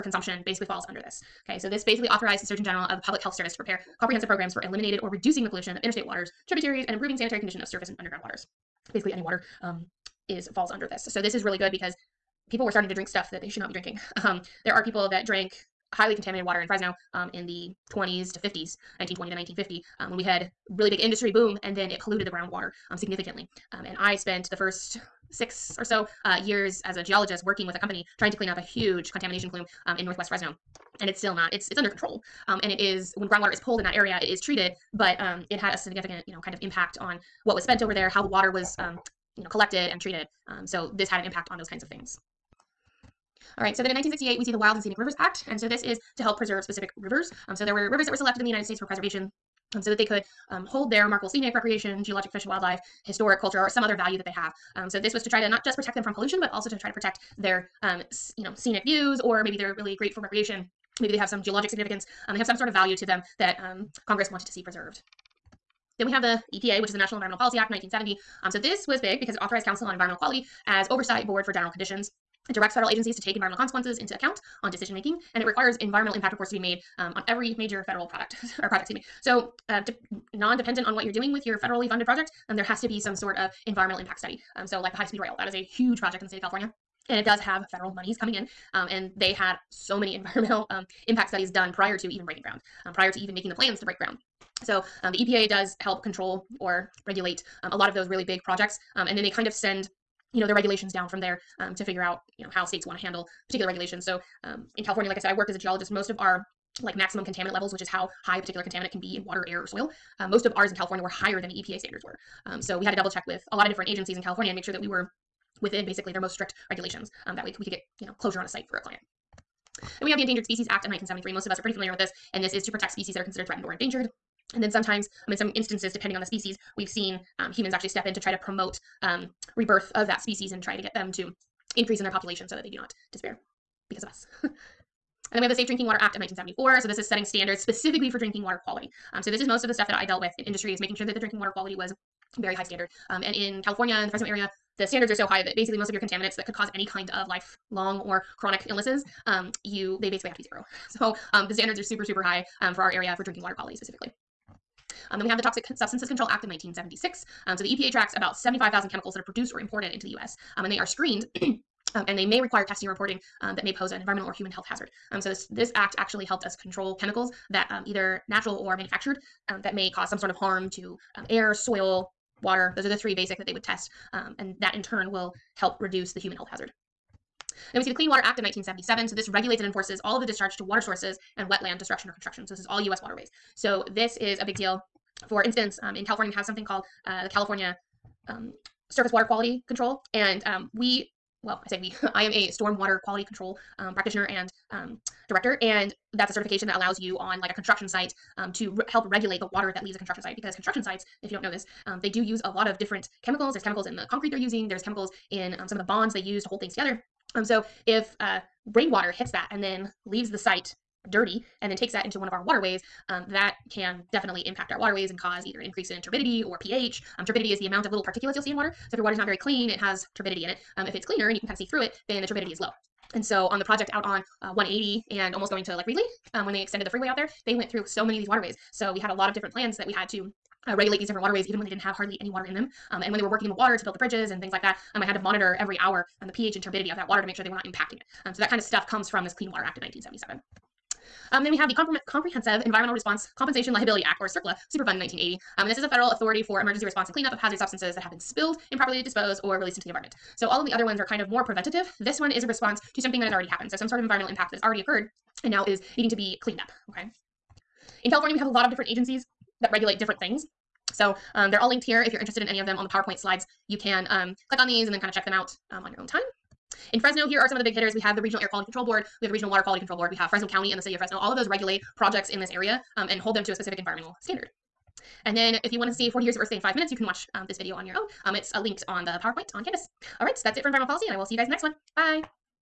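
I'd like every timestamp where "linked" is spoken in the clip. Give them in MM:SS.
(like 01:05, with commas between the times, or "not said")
04:21, 04:38.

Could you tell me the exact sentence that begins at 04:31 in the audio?
All of those regulate projects in this area um, and hold them to a specific environmental standard.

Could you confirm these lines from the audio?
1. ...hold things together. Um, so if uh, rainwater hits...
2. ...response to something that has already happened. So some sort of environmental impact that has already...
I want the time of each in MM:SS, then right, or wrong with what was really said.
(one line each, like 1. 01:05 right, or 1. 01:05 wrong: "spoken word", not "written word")
1. 03:26 right
2. 04:12 right.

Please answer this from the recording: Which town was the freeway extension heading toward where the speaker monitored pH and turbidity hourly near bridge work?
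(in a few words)
Reedley.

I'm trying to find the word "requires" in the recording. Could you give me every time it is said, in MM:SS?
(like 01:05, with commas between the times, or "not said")
01:15, 02:42.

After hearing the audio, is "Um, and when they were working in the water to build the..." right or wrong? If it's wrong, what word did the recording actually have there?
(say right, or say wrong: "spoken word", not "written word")
right.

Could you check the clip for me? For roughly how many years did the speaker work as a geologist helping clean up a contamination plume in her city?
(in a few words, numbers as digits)
6.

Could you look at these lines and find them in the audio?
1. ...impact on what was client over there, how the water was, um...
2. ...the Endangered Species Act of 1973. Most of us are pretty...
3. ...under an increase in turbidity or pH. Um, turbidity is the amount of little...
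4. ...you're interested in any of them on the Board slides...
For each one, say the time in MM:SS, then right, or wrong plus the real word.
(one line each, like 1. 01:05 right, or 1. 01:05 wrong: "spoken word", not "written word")
1. 00:36 wrong: "spent", not "client"
2. 02:00 right
3. 03:35 wrong: "either", not "under"
4. 04:22 wrong: "PowerPoint", not "Board".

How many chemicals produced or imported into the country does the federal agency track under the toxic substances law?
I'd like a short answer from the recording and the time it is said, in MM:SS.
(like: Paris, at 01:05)
75,000, at 02:38.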